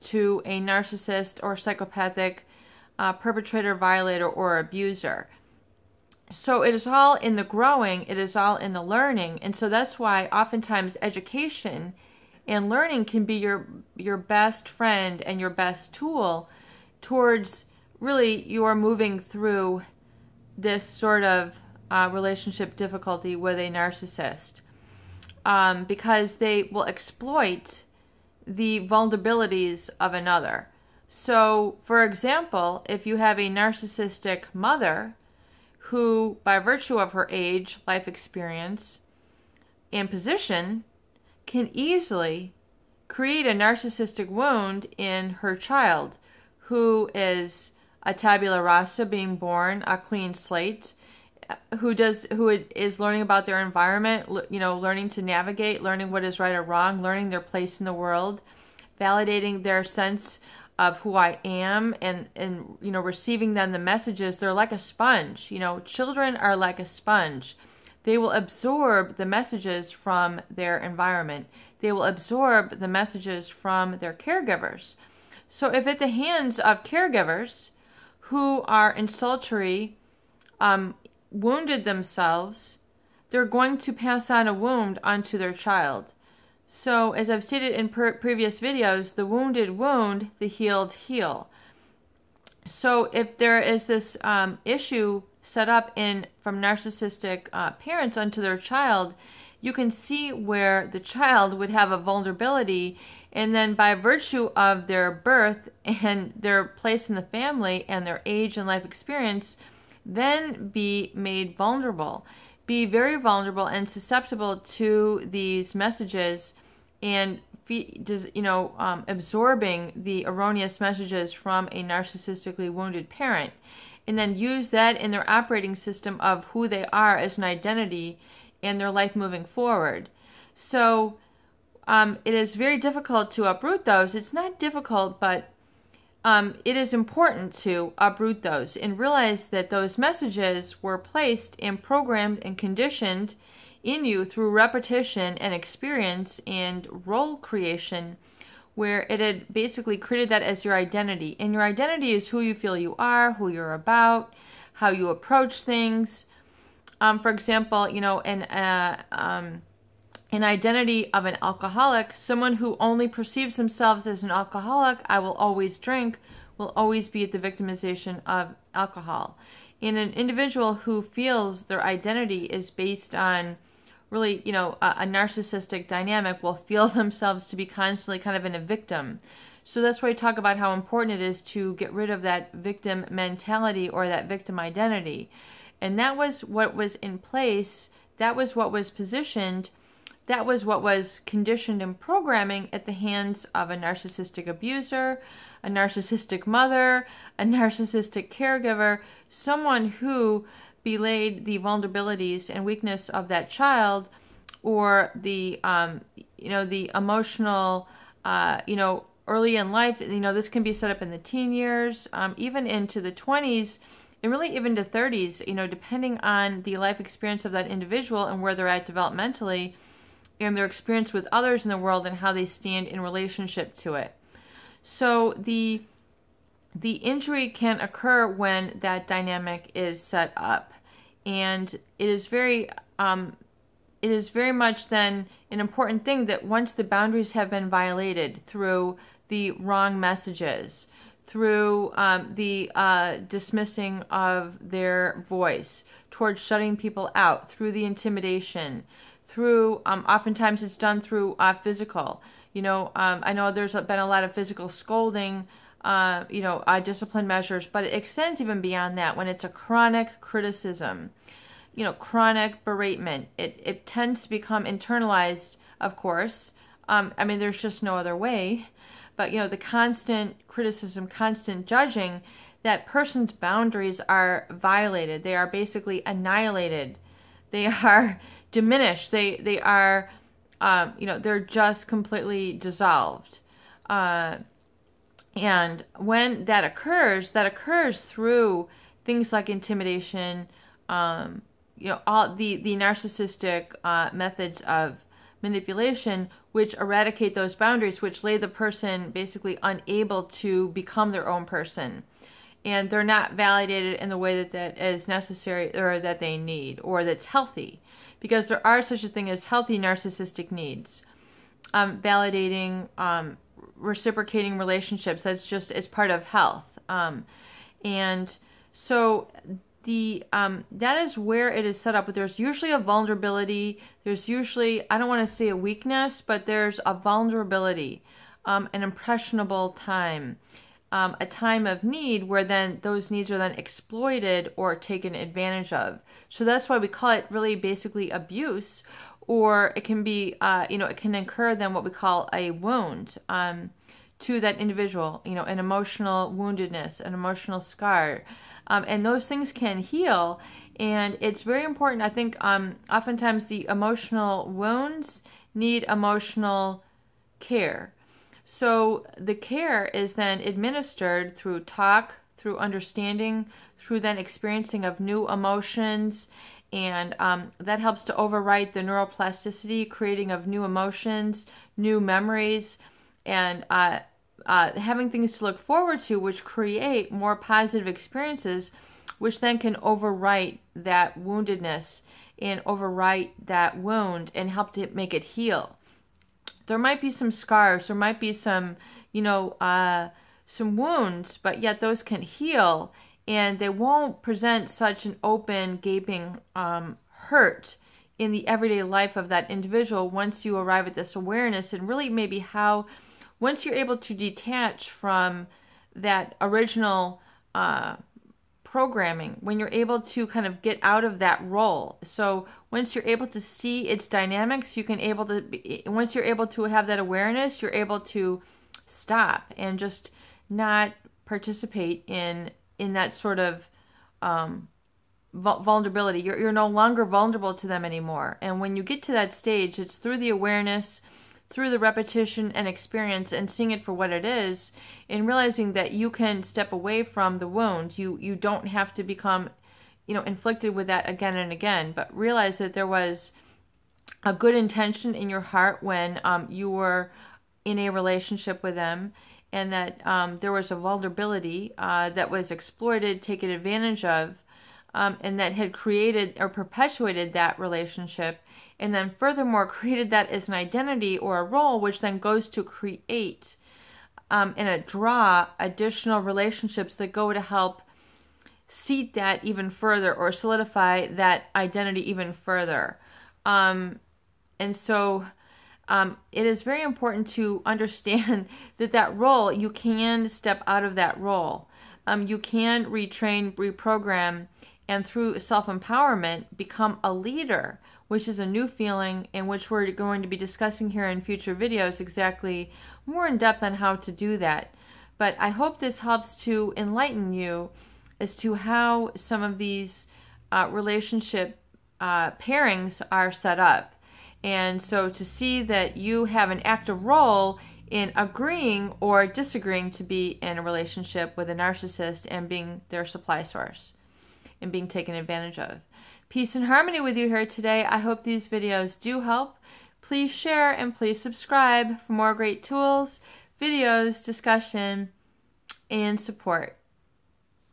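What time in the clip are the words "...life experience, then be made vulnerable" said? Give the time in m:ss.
1:48.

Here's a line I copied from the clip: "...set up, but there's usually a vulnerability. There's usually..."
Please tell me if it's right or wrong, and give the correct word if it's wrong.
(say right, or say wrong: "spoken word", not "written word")
right.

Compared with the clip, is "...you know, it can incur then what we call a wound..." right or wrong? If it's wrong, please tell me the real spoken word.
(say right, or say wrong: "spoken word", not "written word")
right.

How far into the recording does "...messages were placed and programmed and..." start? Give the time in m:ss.
2:19.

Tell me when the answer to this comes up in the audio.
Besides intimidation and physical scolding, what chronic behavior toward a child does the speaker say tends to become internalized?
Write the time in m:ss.
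4:19.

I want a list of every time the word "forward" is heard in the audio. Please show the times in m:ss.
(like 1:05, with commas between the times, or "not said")
2:09, 6:15.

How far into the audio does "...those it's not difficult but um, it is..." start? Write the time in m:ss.
2:13.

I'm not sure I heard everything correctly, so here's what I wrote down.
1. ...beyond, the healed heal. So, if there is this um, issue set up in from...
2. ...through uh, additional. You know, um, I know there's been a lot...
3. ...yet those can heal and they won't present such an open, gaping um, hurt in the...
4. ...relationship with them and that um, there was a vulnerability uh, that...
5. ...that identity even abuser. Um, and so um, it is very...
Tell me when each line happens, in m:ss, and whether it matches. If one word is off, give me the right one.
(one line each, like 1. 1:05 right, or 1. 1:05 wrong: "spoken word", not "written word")
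1. 1:29 wrong: "wound", not "beyond"
2. 4:10 wrong: "physical", not "additional"
3. 6:31 right
4. 7:27 right
5. 7:51 wrong: "further", not "abuser".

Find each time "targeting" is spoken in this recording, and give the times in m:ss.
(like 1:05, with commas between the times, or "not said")
not said.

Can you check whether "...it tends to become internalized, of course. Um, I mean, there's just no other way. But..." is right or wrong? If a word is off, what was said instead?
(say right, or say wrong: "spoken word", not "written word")
right.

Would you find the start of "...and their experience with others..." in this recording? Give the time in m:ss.
3:40.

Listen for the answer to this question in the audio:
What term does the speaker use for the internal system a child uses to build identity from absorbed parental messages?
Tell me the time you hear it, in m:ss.
2:05.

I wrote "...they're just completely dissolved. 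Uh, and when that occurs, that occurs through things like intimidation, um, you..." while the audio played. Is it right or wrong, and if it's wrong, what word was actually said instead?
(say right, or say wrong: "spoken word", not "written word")
right.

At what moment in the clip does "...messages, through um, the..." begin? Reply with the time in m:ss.
3:59.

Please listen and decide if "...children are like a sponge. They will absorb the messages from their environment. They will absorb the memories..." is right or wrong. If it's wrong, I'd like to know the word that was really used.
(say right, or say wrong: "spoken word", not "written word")
wrong: "messages", not "memories".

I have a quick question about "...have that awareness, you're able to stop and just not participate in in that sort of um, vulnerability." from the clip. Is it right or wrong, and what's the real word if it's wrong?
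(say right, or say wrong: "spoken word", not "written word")
right.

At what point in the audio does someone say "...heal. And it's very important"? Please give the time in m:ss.
5:49.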